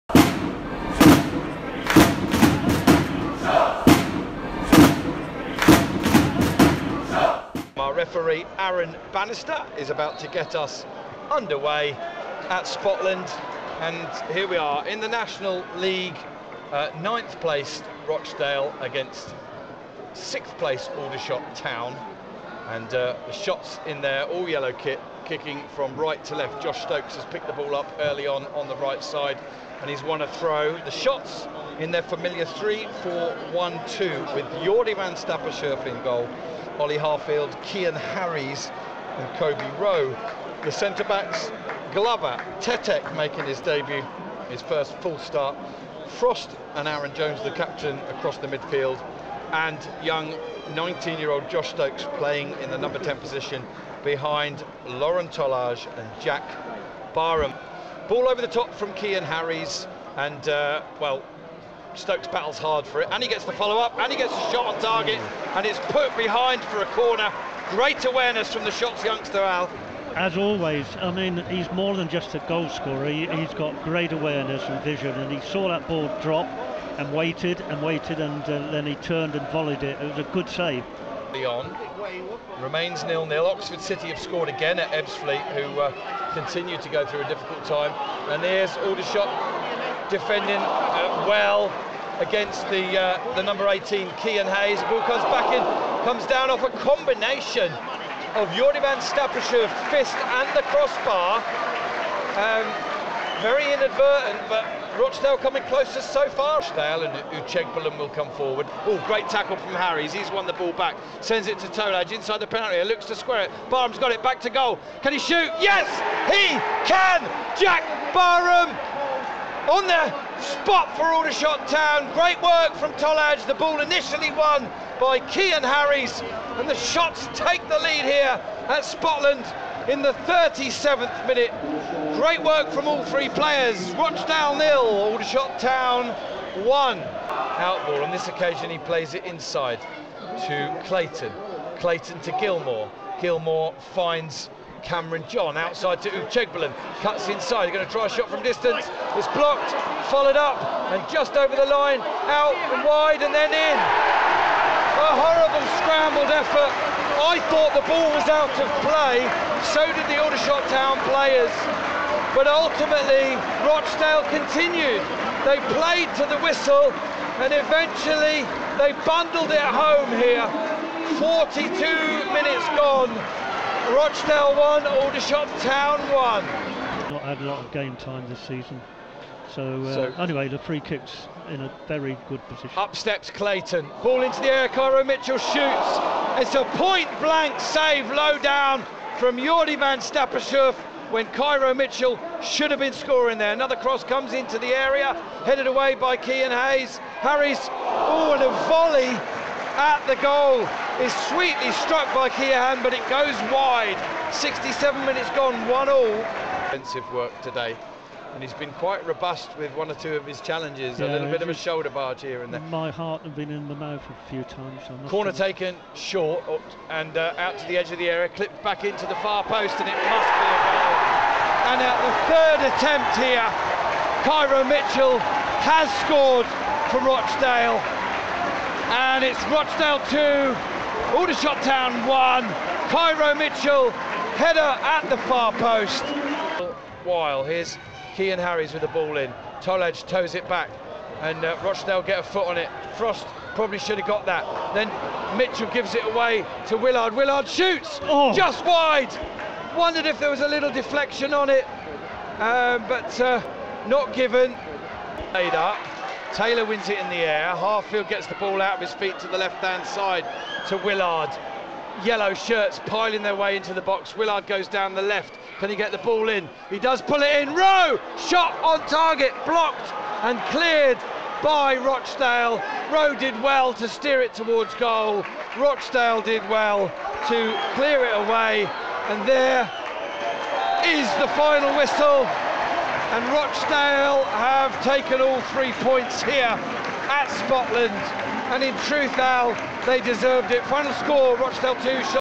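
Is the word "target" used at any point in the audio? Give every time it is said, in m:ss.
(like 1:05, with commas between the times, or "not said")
1:04, 4:28.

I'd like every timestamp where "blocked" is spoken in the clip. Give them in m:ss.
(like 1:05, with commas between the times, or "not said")
2:29, 4:29.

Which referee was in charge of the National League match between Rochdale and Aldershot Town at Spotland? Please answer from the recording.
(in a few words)
Aaron Bannister.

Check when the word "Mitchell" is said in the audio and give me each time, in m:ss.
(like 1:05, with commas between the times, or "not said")
3:05, 3:11, 3:44, 3:53, 4:05.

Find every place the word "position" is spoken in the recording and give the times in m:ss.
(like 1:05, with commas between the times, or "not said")
0:53, 3:02.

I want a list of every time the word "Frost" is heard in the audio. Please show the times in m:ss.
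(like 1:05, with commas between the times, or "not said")
0:46, 4:02.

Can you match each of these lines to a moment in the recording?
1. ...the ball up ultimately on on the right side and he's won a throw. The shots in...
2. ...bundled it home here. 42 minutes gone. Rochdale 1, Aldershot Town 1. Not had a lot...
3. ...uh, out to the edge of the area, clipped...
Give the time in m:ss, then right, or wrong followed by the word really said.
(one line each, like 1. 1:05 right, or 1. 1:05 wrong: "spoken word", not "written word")
1. 0:27 wrong: "early", not "ultimately"
2. 2:49 right
3. 3:37 right.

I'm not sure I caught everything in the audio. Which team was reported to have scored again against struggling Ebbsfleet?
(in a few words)
Oxford City.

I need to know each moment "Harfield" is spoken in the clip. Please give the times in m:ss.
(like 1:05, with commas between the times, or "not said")
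0:36, 4:17.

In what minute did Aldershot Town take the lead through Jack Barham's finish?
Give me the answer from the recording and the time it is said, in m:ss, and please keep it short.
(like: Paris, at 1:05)
37th, at 2:10.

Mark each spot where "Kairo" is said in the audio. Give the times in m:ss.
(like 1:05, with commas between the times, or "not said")
3:04, 3:11, 3:44, 3:52.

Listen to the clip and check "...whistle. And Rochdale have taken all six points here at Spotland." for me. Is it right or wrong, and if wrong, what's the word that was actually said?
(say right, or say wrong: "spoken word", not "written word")
wrong: "three", not "six".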